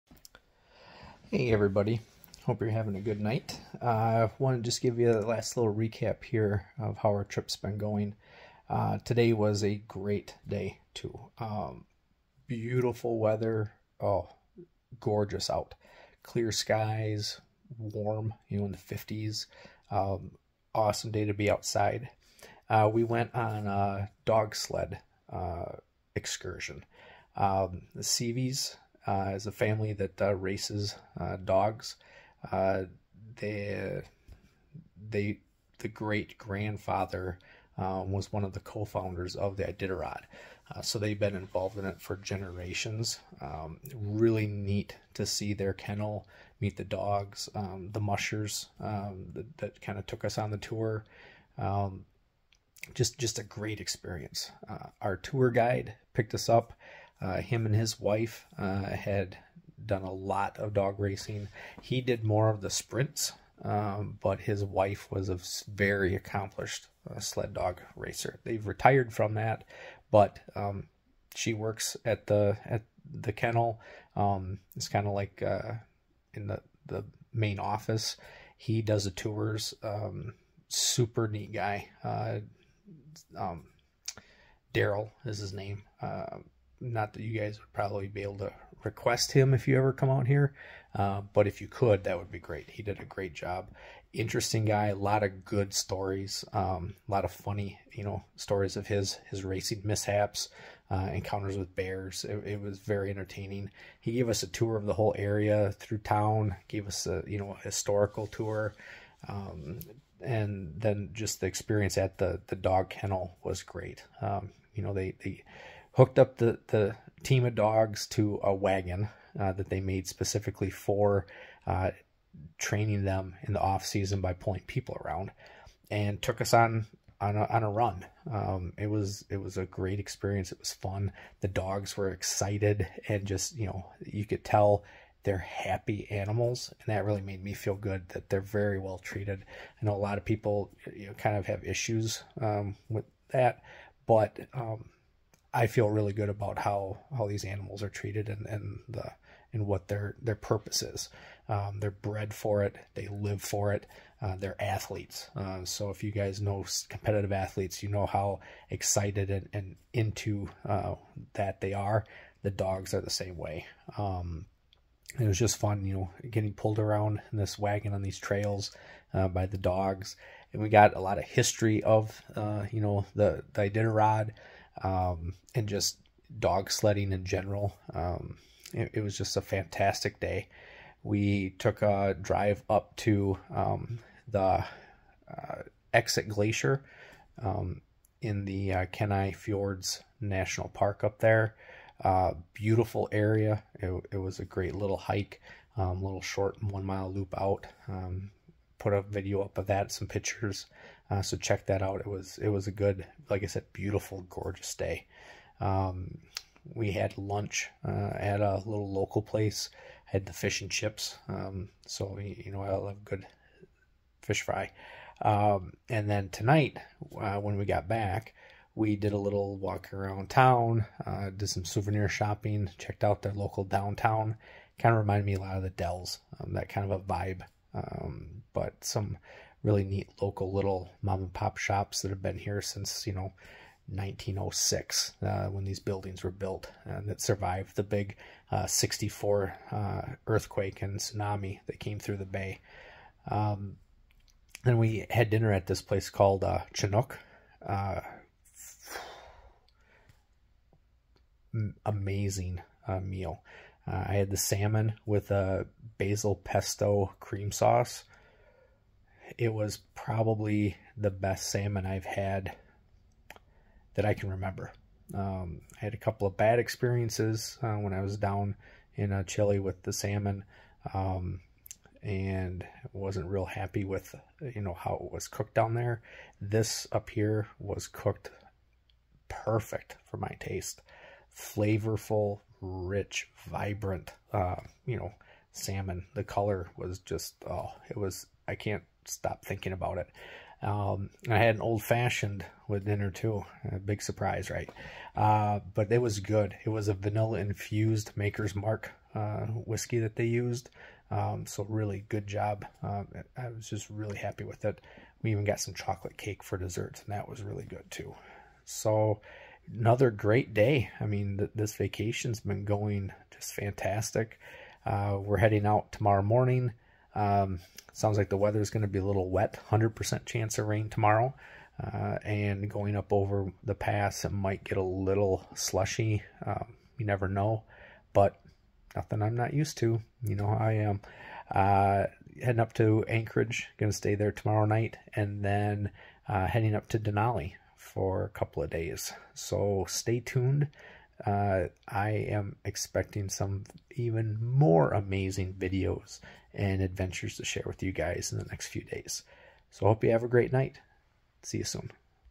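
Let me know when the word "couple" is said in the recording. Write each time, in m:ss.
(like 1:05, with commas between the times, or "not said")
4:25, 5:38.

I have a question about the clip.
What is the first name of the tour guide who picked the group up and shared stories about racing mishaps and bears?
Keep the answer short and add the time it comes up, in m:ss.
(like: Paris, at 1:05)
Daryl, at 1:24.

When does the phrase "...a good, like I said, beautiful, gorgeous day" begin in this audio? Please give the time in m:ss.
3:22.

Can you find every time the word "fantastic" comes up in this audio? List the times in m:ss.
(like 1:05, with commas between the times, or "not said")
2:59, 5:13.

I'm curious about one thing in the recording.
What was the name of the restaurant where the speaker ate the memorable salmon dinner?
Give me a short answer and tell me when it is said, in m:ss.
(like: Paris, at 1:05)
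Chinook, at 4:06.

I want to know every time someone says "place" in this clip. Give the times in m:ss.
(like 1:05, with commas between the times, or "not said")
3:29, 4:05.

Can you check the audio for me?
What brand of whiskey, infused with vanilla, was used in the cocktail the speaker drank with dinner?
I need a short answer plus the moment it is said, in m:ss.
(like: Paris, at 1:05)
Maker's Mark, at 4:58.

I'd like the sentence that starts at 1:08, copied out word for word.
They've retired from that, but um, she works at the at the kennel.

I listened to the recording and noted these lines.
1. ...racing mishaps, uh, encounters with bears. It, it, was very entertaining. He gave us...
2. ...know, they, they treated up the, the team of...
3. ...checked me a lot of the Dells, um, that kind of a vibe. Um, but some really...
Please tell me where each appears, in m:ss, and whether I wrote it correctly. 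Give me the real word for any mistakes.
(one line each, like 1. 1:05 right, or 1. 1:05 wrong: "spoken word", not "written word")
1. 1:39 right
2. 1:54 wrong: "hooked", not "treated"
3. 3:45 wrong: "reminded", not "checked".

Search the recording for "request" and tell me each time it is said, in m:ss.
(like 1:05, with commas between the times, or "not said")
1:28.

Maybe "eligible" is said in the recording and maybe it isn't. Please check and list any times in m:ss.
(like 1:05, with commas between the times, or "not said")
not said.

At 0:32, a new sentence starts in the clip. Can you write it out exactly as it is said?
Uh, they, they, the great grandfather uh, was one of the co-founders of the Iditarod.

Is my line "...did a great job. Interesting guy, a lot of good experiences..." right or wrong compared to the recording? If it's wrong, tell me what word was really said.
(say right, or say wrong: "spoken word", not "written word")
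wrong: "stories", not "experiences".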